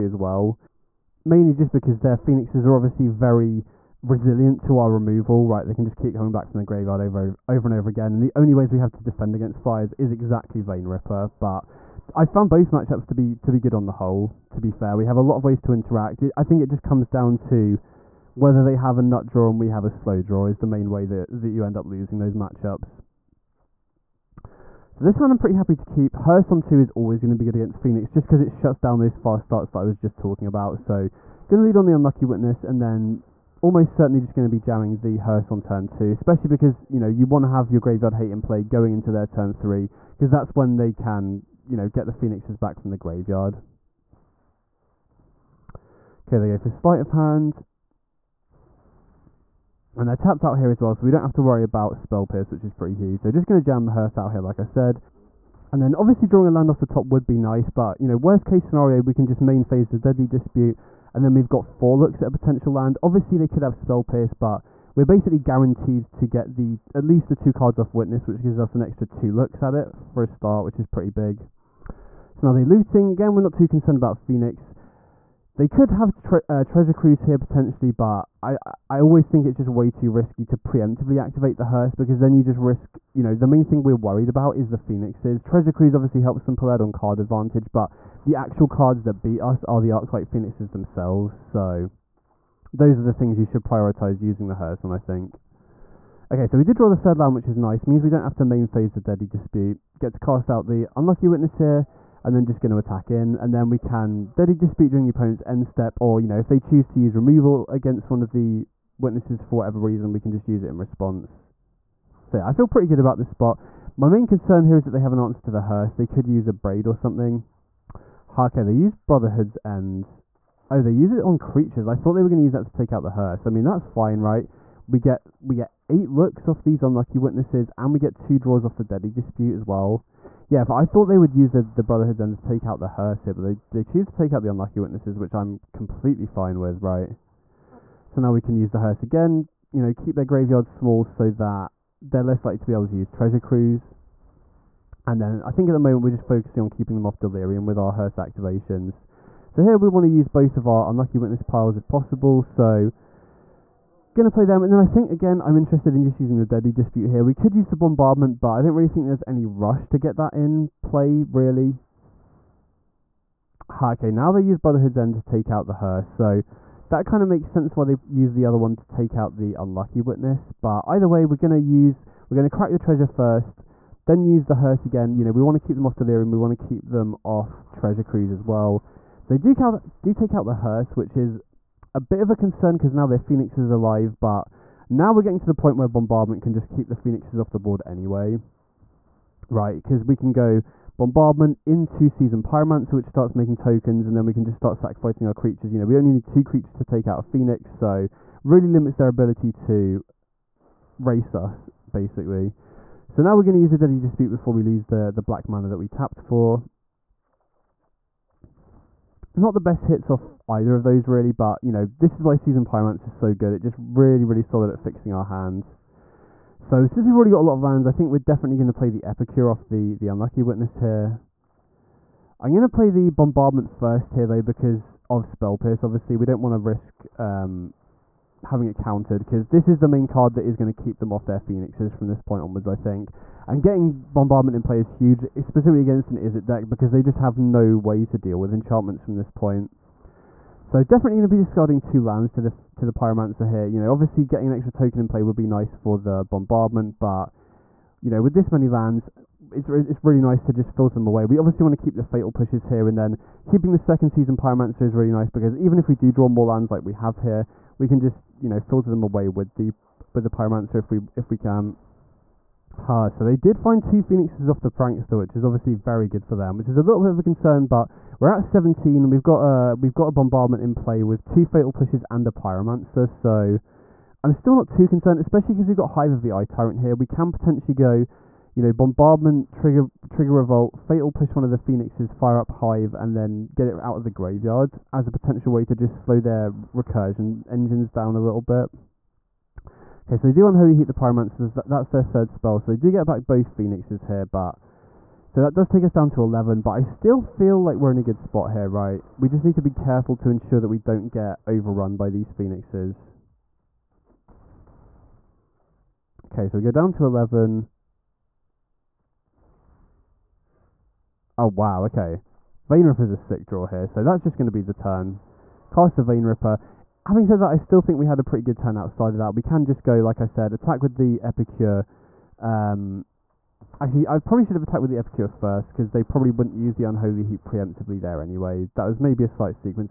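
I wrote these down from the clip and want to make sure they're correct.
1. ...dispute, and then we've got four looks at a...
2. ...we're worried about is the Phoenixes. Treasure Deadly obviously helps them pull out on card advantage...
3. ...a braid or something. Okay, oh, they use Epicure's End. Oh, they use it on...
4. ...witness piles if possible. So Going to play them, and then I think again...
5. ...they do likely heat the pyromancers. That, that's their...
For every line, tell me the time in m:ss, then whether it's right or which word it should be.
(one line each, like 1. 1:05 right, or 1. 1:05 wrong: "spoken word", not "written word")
1. 1:00 right
2. 1:23 wrong: "Cruise", not "Deadly"
3. 1:56 wrong: "Brotherhood", not "Epicure"
4. 2:31 right
5. 4:50 wrong: "unholy", not "likely".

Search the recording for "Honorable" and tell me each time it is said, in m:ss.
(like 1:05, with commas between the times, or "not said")
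not said.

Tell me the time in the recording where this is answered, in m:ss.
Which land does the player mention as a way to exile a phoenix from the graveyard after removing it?
4:35.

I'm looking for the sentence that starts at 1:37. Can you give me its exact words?
Means we don't have to main phase the Deadly Dispute.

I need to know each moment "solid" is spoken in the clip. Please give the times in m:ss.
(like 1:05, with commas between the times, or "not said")
3:34.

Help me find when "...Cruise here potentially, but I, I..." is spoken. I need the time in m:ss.
1:16.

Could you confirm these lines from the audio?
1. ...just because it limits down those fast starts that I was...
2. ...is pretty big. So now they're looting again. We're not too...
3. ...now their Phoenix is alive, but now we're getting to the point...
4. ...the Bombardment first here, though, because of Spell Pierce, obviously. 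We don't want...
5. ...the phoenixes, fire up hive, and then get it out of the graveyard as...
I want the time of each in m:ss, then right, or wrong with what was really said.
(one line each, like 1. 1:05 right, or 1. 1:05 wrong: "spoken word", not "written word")
1. 0:28 wrong: "shuts", not "limits"
2. 1:10 right
3. 3:02 right
4. 3:42 right
5. 4:41 right.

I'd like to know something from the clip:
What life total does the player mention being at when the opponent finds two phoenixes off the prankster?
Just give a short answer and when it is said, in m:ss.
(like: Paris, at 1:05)
17, at 4:28.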